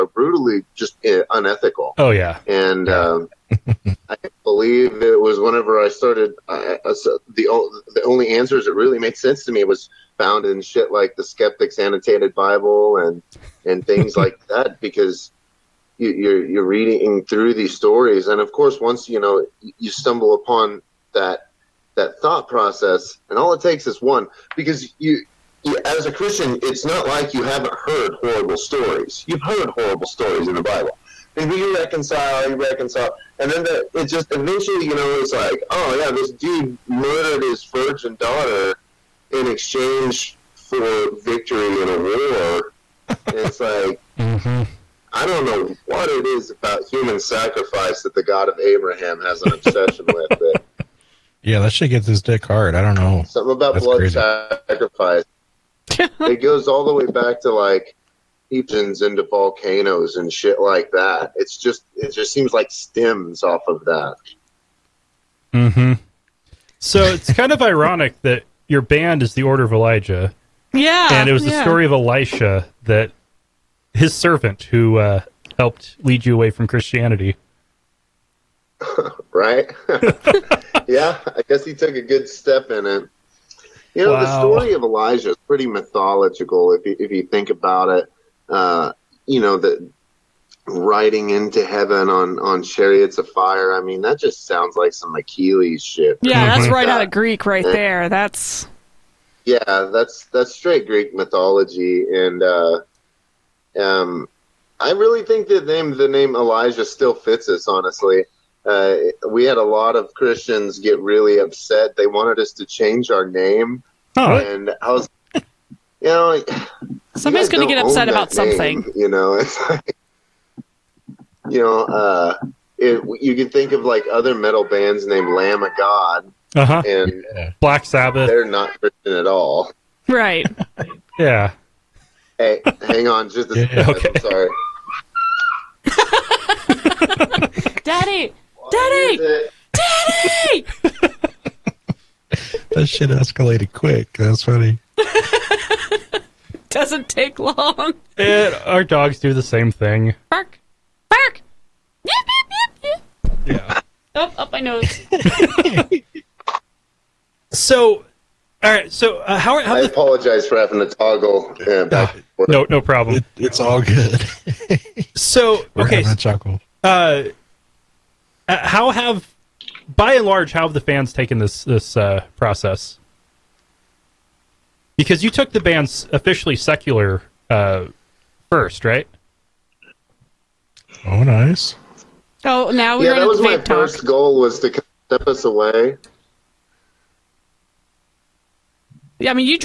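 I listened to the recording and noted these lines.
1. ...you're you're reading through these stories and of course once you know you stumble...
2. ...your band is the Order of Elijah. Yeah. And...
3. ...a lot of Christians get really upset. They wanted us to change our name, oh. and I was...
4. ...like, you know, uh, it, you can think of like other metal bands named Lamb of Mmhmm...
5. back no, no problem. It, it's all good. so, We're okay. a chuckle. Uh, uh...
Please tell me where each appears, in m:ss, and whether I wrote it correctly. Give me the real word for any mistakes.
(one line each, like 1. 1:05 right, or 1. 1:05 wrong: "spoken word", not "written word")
1. 0:16 right
2. 1:08 right
3. 1:49 right
4. 1:59 wrong: "God", not "Mmhmm"
5. 2:41 right.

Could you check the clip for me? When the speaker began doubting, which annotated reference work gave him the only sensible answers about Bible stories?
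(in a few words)
Skeptics Annotated Bible.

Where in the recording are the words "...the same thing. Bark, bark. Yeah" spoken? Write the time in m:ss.
2:29.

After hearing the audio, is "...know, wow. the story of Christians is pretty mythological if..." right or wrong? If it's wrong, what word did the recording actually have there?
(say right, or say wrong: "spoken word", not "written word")
wrong: "Elijah", not "Christians".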